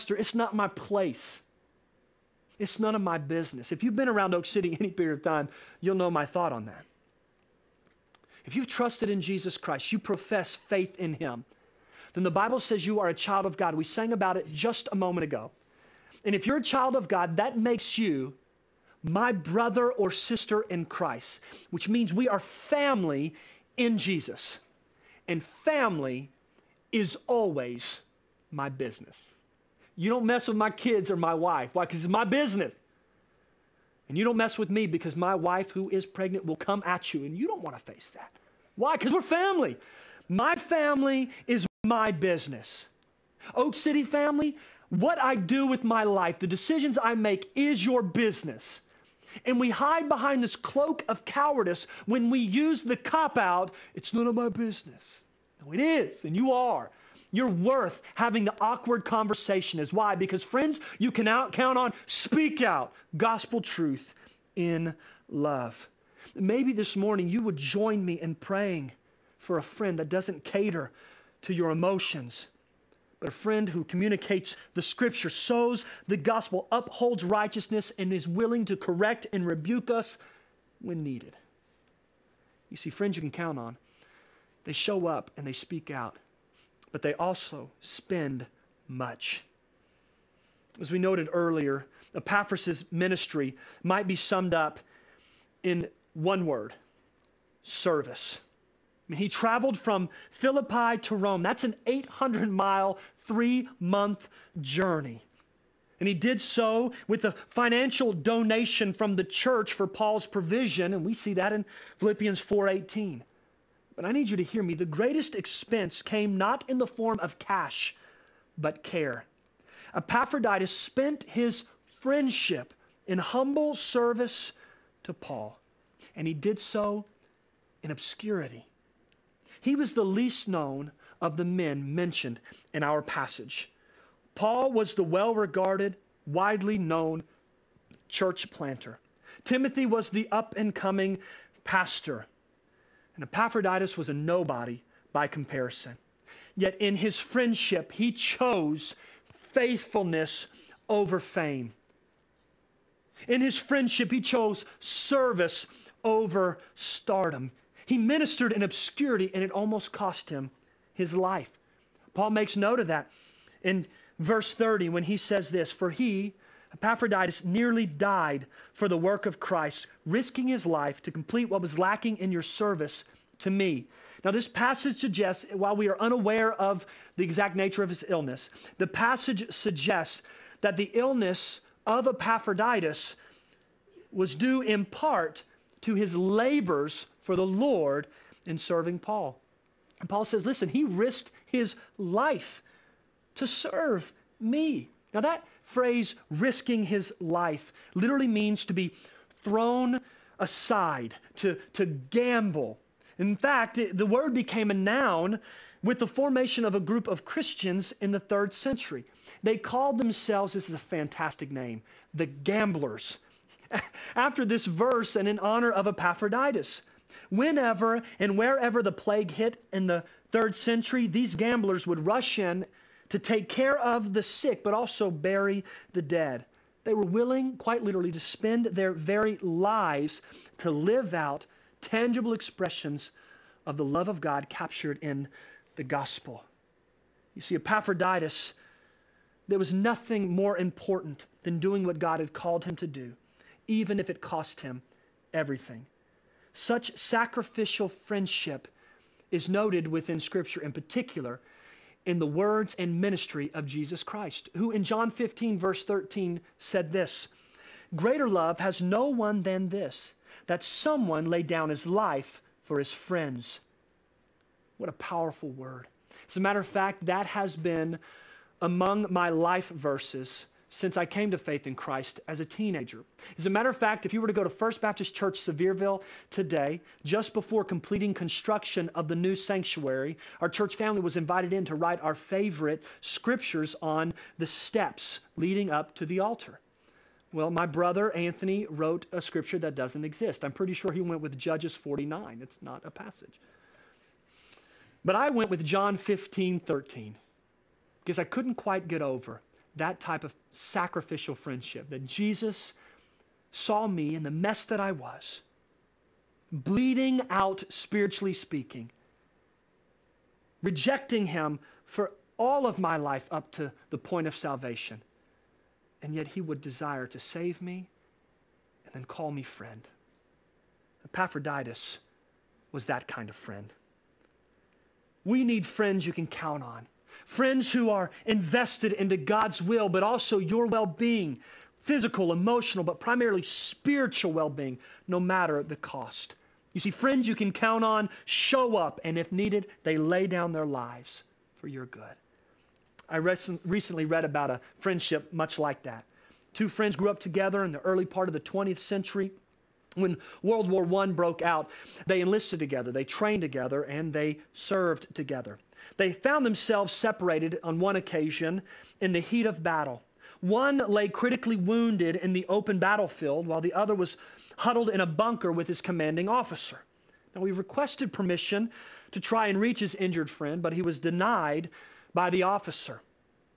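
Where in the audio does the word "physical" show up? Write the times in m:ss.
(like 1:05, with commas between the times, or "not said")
5:31.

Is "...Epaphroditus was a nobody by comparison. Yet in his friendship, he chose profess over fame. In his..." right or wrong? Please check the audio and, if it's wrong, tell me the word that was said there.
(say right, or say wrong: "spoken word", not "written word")
wrong: "faithfulness", not "profess".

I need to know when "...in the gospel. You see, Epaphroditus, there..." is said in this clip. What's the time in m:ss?
3:55.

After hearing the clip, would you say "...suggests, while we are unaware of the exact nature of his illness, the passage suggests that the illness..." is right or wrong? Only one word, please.
right.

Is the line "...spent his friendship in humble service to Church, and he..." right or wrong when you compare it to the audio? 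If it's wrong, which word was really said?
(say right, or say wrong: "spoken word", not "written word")
wrong: "Paul", not "Church".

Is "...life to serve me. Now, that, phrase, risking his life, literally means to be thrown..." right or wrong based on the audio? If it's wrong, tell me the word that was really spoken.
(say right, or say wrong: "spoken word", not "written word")
right.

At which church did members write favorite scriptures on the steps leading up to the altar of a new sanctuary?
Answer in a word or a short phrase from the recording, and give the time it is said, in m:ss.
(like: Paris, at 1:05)
First Baptist Church Sevierville, at 4:34.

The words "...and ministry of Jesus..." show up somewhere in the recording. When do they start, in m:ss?
4:12.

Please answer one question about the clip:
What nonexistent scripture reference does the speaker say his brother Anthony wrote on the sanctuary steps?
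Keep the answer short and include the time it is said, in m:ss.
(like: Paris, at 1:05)
Judges 49, at 4:51.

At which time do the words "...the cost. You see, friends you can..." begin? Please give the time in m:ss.
5:35.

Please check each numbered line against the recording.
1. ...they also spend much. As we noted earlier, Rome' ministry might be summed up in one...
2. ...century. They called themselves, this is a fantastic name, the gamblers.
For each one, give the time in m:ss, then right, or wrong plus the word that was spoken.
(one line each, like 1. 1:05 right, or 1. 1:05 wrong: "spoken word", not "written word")
1. 1:27 wrong: "Epaphras", not "Rome"
2. 3:28 right.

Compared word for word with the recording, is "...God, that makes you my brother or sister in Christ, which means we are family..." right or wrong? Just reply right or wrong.
right.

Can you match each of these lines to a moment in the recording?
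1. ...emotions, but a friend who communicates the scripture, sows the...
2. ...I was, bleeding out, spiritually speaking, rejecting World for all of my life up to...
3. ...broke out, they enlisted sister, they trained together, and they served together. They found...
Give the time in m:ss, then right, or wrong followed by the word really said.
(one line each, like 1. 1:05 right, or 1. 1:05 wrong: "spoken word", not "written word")
1. 1:11 right
2. 5:04 wrong: "Him", not "World"
3. 5:51 wrong: "together", not "sister".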